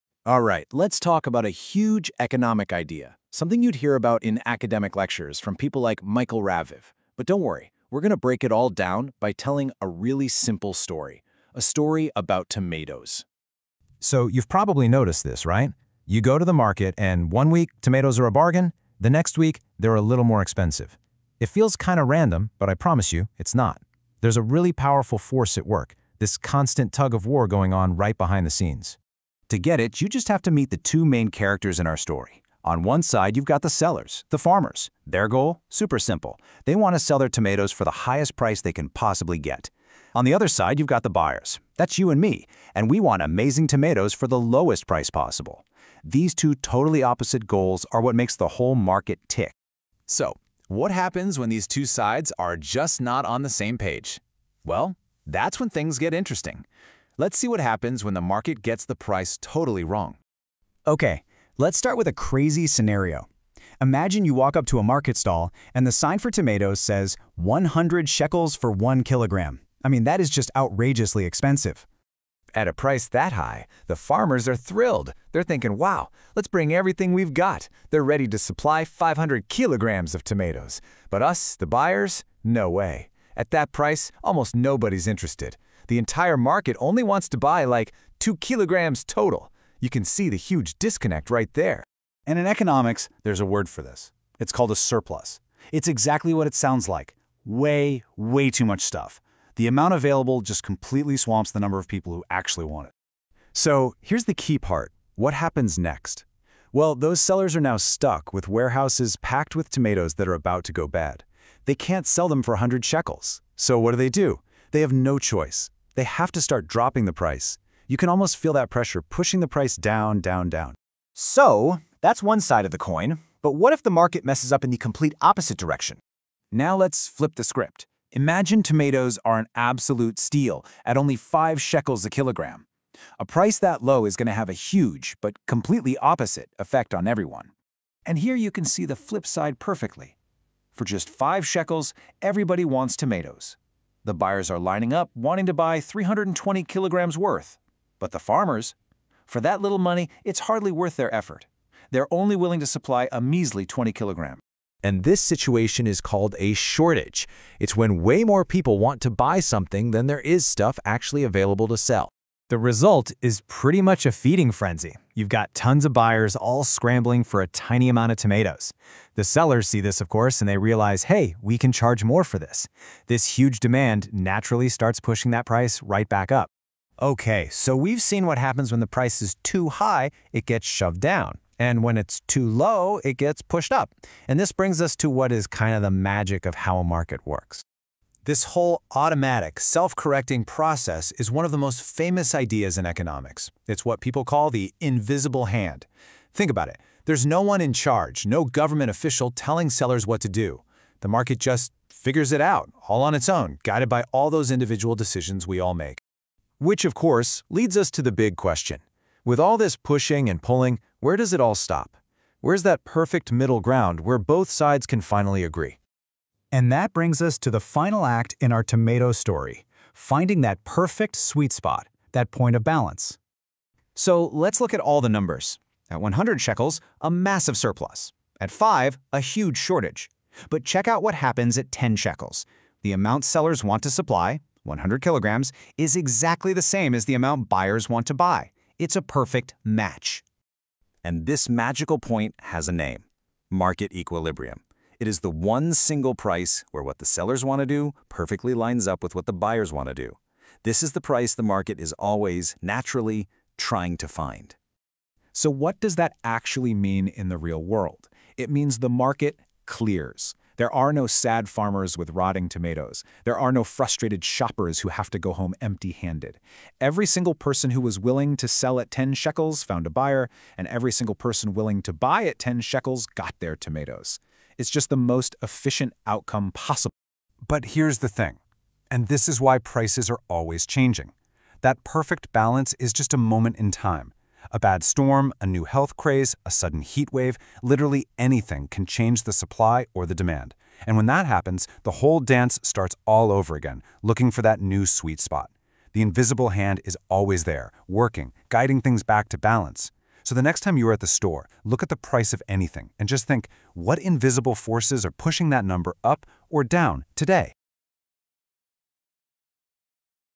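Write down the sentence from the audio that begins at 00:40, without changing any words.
On the other side, you've got the buyers.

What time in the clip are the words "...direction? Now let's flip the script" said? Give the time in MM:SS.
02:05.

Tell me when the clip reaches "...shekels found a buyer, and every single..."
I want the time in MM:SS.
04:29.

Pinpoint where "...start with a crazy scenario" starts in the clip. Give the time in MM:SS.
01:01.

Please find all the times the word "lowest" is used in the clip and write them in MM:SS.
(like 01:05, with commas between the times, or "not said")
00:44.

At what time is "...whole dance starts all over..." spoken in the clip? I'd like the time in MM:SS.
04:51.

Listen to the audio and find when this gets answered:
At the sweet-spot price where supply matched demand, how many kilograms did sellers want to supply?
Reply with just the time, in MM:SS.
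03:54.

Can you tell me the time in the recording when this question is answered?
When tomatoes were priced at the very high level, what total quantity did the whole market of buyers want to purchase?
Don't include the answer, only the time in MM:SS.
01:28.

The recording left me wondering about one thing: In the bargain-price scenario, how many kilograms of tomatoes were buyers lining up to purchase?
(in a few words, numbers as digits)
320 kilograms.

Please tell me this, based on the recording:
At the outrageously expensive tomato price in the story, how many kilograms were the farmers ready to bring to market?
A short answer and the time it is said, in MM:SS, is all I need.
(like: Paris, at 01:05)
500 kilograms, at 01:18.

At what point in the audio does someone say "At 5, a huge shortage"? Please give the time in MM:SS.
03:48.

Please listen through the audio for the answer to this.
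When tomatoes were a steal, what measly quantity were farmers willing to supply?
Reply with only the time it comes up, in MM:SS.
02:33.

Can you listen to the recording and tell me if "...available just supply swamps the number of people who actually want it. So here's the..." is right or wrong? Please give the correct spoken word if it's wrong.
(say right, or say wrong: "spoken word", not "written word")
wrong: "completely", not "supply".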